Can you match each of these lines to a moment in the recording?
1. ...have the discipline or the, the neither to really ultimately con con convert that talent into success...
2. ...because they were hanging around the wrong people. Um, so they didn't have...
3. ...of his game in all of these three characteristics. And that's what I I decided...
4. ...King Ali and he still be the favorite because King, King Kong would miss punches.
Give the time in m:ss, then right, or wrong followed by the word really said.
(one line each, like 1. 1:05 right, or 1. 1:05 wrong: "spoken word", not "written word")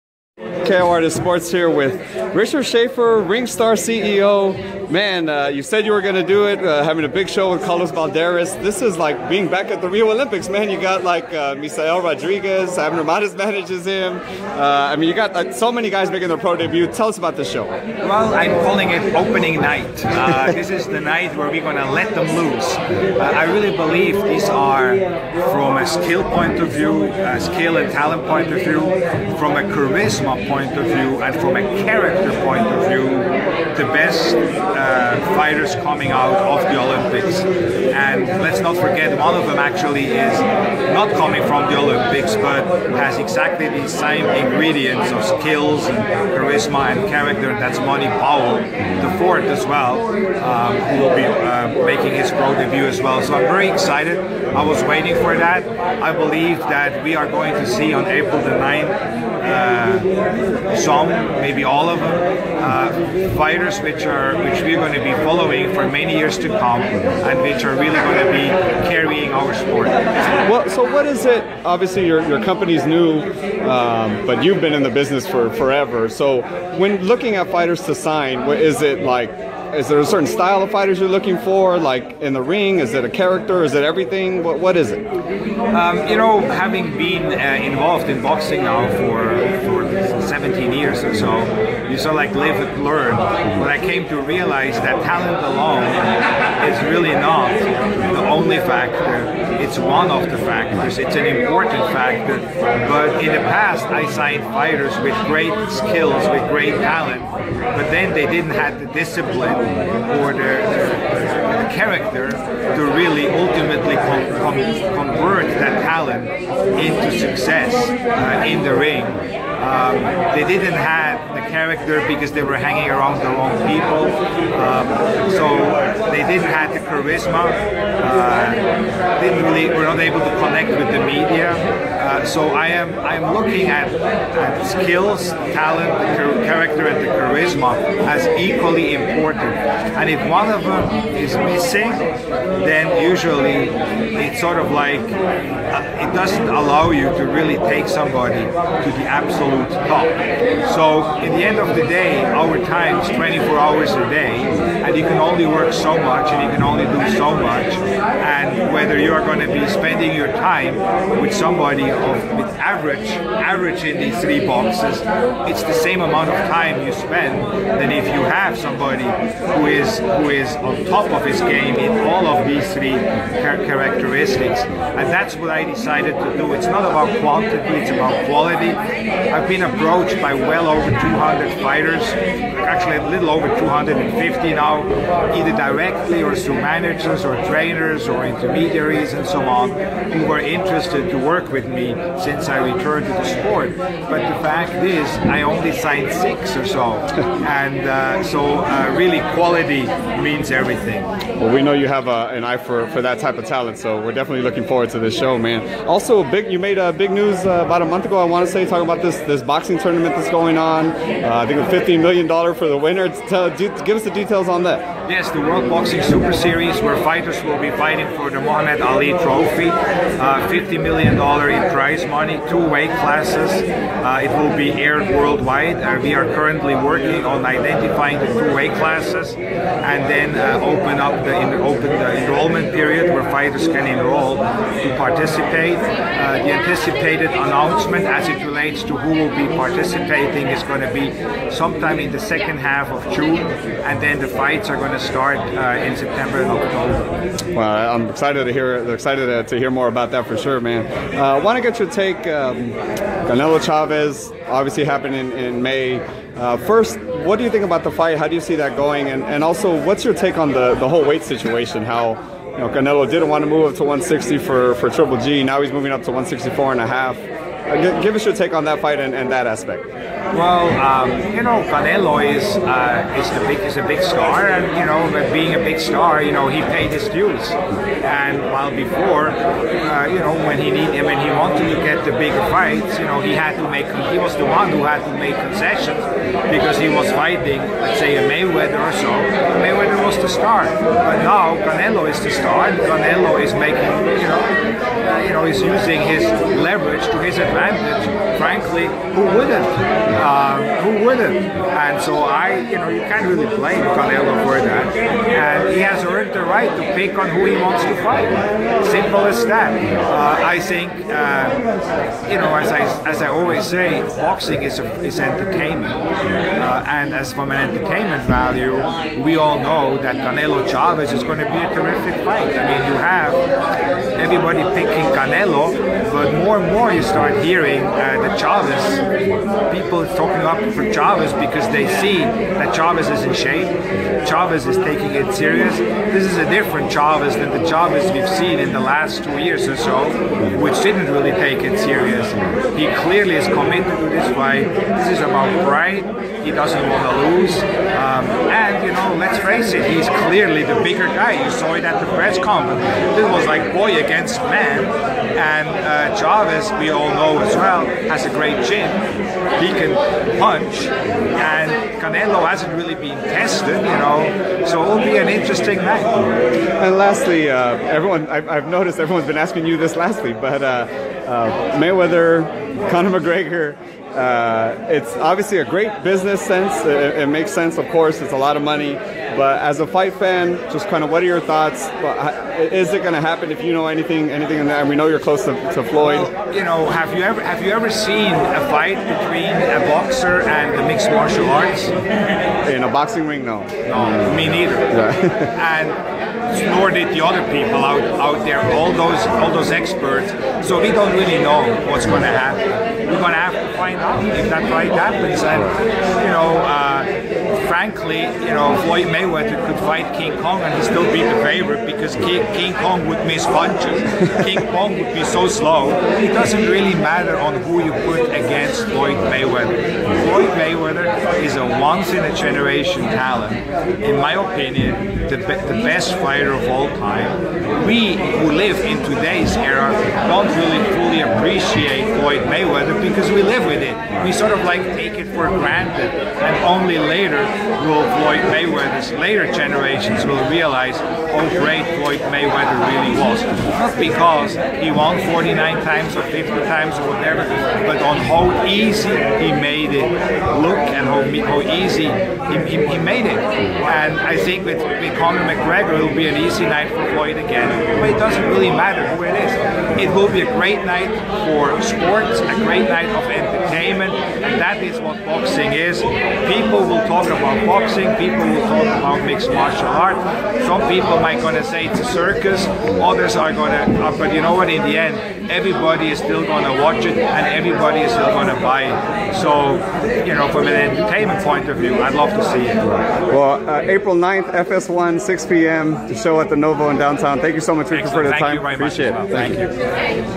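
1. 1:48 wrong: "character", not "neither"
2. 2:02 right
3. 2:51 right
4. 6:50 wrong: "Kong", not "Ali".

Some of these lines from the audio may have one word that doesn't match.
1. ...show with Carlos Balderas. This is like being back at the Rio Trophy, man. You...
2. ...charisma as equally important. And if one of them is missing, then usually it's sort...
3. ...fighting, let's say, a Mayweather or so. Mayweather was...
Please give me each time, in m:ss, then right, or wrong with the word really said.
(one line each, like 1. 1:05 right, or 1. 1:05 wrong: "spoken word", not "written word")
1. 0:07 wrong: "Olympics", not "Trophy"
2. 2:17 right
3. 4:47 right.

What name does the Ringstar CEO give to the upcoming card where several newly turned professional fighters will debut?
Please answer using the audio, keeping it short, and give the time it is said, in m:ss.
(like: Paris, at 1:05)
Opening night, at 0:19.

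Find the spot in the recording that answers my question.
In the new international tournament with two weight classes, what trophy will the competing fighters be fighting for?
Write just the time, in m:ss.
3:38.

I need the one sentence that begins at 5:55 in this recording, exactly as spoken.
And uh, Chavez, we all know as well, has a great chin.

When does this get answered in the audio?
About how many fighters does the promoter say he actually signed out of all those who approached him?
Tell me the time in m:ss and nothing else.
3:16.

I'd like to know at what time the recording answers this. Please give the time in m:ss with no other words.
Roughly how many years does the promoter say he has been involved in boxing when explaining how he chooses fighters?
1:30.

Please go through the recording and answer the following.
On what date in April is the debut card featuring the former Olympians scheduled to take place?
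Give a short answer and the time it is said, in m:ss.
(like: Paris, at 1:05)
April 9, at 0:58.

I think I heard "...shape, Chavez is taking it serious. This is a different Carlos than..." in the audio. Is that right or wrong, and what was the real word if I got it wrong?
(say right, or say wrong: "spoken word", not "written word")
wrong: "Chavez", not "Carlos".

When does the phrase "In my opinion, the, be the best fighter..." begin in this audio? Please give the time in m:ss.
7:04.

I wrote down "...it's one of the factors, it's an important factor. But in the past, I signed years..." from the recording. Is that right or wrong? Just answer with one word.
wrong.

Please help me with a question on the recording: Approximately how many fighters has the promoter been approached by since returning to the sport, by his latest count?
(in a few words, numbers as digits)
A little over 250.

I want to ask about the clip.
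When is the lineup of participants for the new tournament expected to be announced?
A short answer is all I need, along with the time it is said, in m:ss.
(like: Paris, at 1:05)
Second half of June, at 4:02.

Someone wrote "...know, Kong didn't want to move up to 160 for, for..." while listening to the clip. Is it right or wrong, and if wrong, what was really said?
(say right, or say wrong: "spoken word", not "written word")
wrong: "Canelo", not "Kong".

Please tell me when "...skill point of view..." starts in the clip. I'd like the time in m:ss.
0:25.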